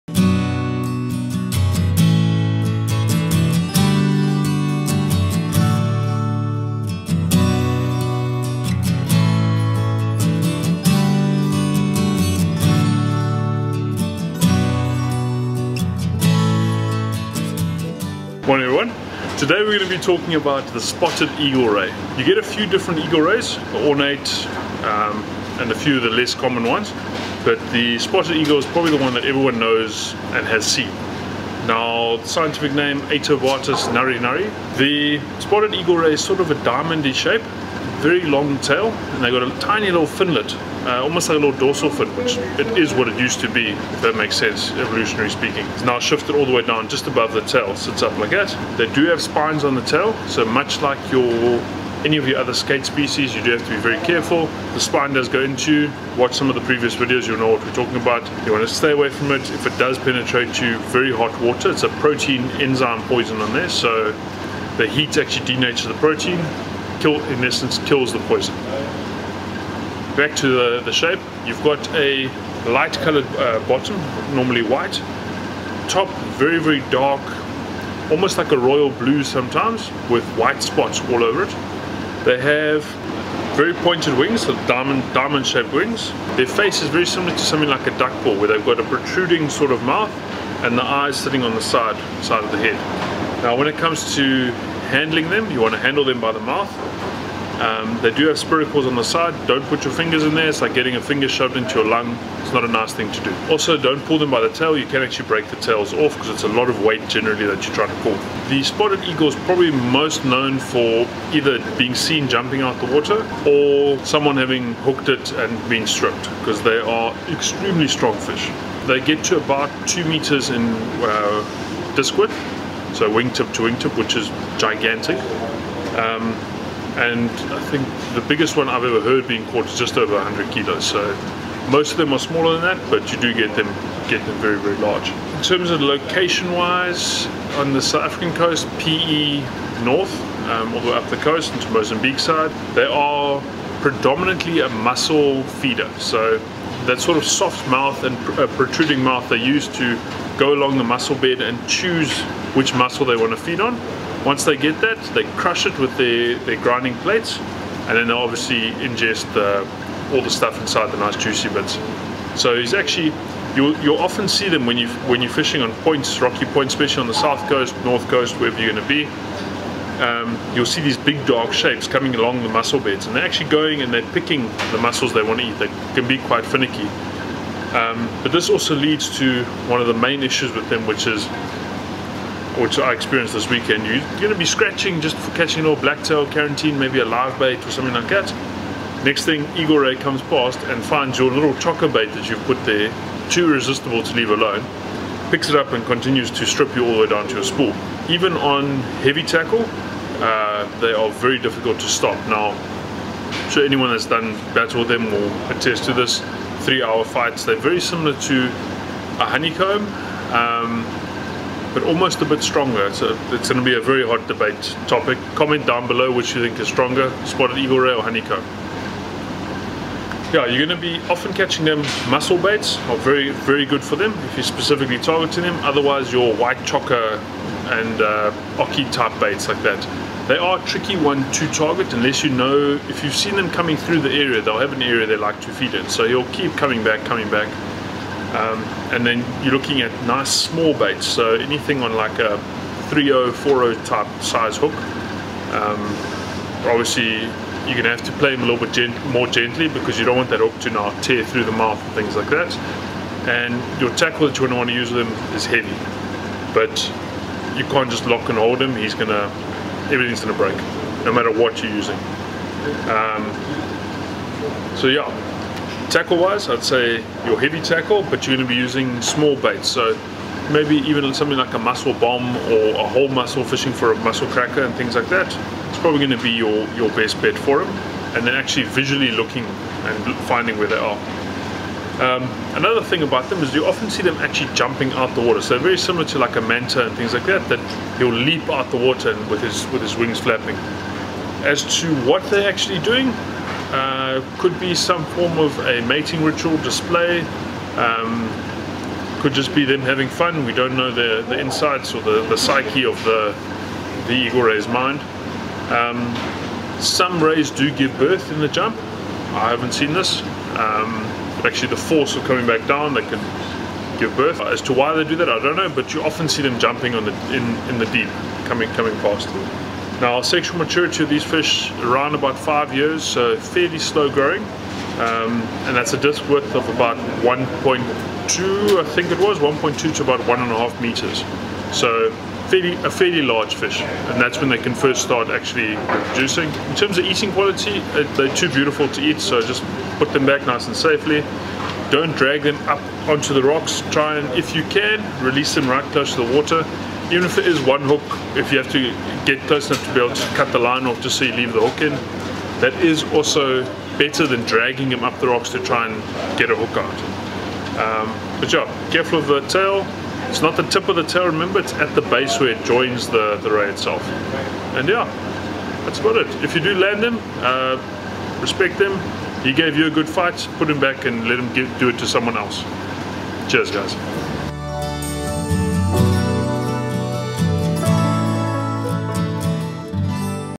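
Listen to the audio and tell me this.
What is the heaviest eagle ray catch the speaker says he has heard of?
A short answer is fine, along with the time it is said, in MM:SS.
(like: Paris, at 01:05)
Just over 100 kilos, at 02:09.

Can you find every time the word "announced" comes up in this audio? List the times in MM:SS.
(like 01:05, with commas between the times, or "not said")
not said.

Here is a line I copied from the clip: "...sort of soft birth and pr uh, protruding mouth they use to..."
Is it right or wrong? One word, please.
wrong.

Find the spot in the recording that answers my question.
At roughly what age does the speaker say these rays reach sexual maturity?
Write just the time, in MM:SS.
05:22.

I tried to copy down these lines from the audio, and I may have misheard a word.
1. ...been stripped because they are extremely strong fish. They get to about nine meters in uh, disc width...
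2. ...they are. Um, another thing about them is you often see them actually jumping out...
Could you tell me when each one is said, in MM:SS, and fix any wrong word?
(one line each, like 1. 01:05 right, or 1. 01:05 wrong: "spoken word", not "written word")
1. 01:55 wrong: "two", not "nine"
2. 04:40 right.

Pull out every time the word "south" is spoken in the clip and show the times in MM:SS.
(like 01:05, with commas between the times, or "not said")
02:17, 02:47.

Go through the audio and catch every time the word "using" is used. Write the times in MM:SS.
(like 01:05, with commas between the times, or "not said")
04:21, 04:28.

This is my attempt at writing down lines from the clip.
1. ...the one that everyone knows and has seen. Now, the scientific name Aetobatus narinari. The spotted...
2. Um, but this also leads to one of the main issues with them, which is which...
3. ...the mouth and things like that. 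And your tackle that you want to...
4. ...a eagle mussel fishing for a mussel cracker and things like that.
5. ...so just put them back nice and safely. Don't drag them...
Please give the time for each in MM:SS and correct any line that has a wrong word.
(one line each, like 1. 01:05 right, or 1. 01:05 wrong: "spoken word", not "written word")
1. 00:28 right
2. 02:57 right
3. 04:11 right
4. 04:32 wrong: "whole", not "eagle"
5. 05:39 right.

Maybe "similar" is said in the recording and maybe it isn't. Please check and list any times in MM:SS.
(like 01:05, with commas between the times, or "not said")
01:27, 03:27, 04:45.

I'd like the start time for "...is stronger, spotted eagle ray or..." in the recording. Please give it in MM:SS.
03:36.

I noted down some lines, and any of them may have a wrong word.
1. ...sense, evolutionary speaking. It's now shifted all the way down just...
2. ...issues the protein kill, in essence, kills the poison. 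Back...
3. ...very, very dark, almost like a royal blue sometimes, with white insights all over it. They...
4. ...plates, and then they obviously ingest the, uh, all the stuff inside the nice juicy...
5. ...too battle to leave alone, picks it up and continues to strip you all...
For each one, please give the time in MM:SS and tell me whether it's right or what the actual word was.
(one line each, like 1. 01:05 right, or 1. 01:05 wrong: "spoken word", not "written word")
1. 00:44 right
2. 01:05 wrong: "denatures", not "issues"
3. 01:16 wrong: "spots", not "insights"
4. 02:36 right
5. 03:13 wrong: "irresistible", not "battle".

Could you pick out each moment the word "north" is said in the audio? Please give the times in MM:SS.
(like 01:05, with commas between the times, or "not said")
02:19, 02:47.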